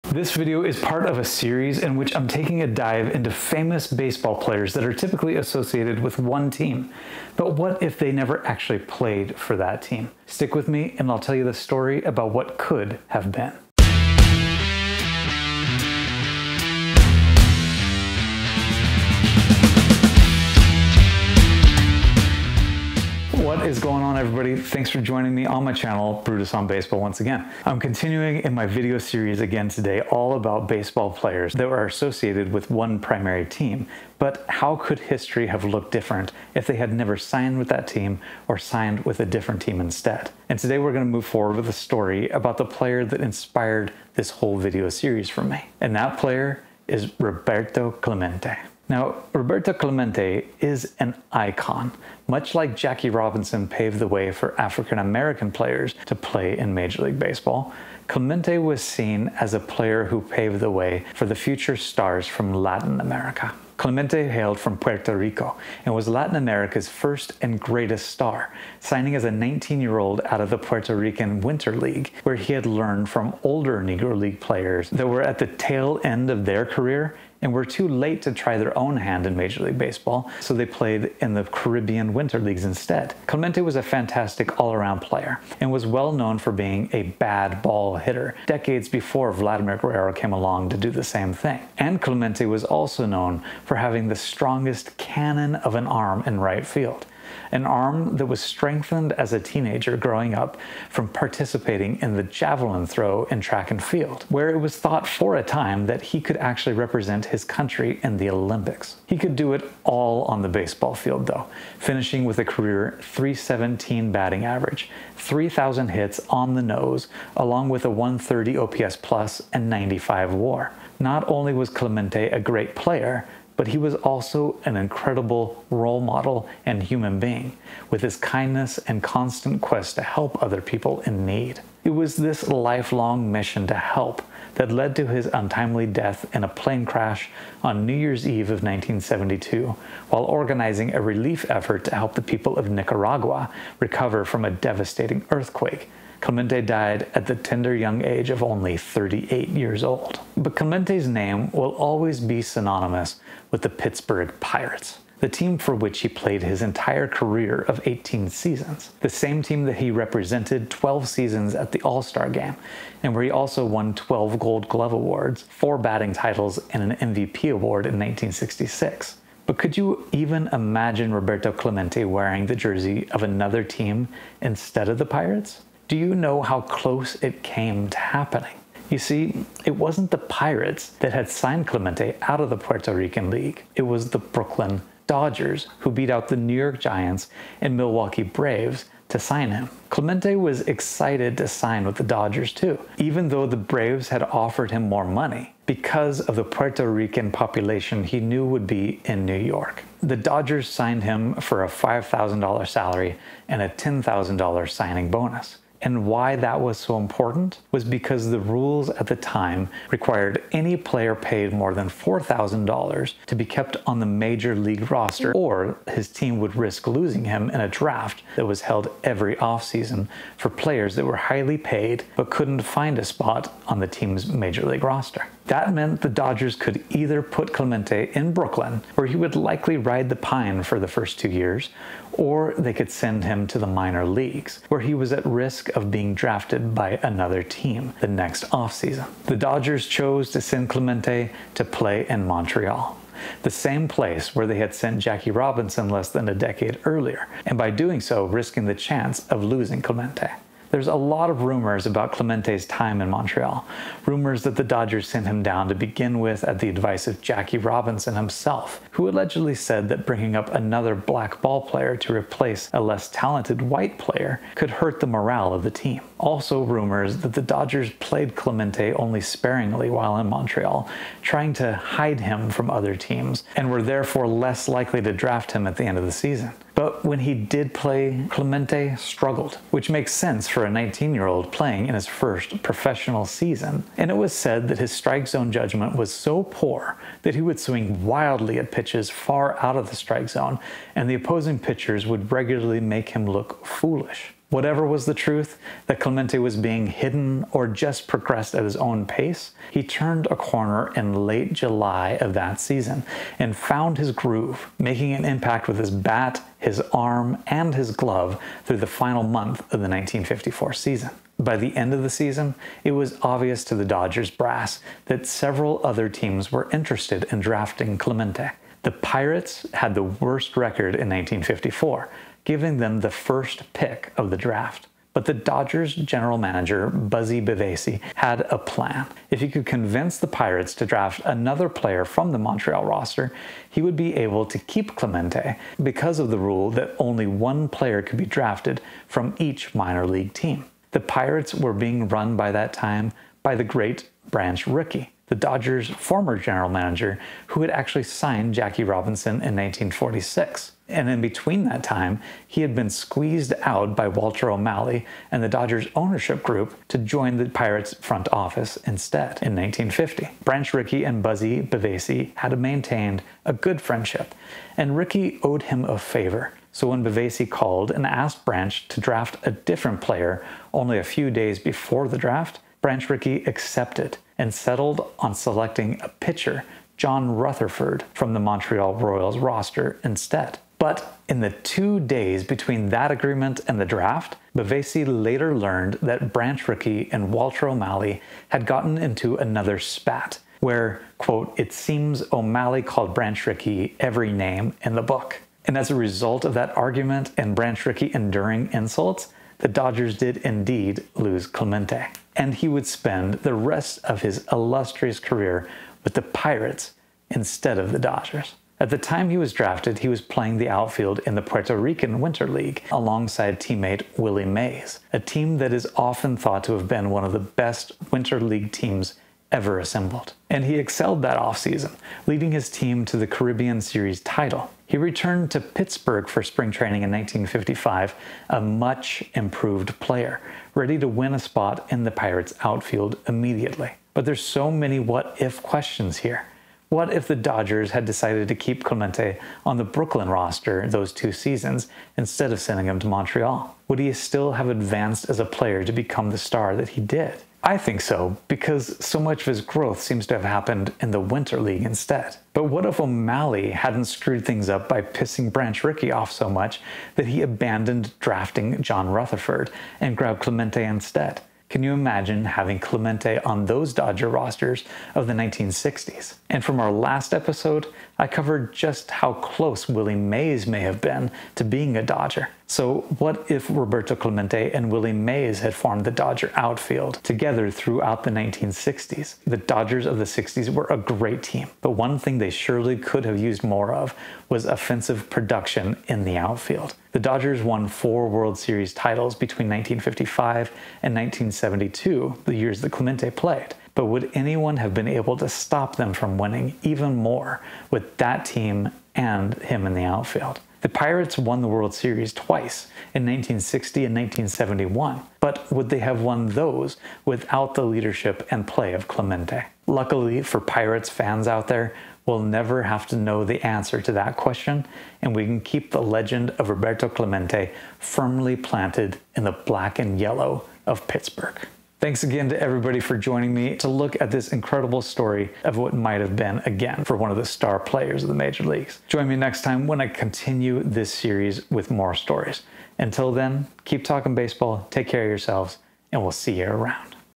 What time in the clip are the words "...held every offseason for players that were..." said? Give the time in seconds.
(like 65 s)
218 s.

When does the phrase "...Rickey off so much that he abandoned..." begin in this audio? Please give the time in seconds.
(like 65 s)
455 s.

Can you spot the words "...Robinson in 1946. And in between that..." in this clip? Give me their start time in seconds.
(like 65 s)
348 s.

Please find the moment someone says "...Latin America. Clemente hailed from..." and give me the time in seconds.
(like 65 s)
62 s.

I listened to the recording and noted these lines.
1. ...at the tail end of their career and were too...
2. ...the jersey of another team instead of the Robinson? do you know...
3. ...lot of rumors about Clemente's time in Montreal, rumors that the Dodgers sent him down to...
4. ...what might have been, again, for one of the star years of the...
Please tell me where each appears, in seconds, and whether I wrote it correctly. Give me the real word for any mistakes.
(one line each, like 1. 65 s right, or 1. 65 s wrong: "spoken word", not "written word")
1. 75 s right
2. 172 s wrong: "Pirates", not "Robinson"
3. 250 s right
4. 525 s wrong: "players", not "years".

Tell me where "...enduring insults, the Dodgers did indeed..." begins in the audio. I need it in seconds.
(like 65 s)
398 s.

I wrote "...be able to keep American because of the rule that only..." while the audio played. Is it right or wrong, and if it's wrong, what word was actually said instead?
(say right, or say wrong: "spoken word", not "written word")
wrong: "Clemente", not "American".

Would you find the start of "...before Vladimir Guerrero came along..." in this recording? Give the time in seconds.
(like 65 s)
88 s.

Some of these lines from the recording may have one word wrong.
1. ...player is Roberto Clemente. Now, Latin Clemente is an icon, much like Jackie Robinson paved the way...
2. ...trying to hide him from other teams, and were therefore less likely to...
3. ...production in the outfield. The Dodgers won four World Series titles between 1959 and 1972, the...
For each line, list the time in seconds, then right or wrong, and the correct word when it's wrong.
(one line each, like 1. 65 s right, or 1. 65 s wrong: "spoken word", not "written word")
1. 46 s wrong: "Roberto", not "Latin"
2. 271 s right
3. 485 s wrong: "1955", not "1959".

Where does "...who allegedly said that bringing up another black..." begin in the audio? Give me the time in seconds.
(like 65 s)
258 s.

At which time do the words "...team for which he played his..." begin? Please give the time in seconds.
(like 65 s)
155 s.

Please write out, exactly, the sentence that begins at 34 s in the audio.
But how could history have looked different if they had never signed with that team or signed with a different team instead?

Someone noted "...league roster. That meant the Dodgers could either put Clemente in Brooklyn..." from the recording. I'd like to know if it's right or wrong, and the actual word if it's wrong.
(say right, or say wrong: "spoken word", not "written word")
right.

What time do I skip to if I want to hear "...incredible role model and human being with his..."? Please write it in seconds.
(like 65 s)
124 s.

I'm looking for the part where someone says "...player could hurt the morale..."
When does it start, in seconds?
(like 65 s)
263 s.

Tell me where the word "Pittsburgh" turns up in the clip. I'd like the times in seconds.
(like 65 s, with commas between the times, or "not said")
153 s, 425 s, 521 s.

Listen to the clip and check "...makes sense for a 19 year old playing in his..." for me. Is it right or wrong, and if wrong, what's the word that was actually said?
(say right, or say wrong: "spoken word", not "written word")
right.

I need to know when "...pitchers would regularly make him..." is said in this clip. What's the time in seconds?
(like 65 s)
291 s.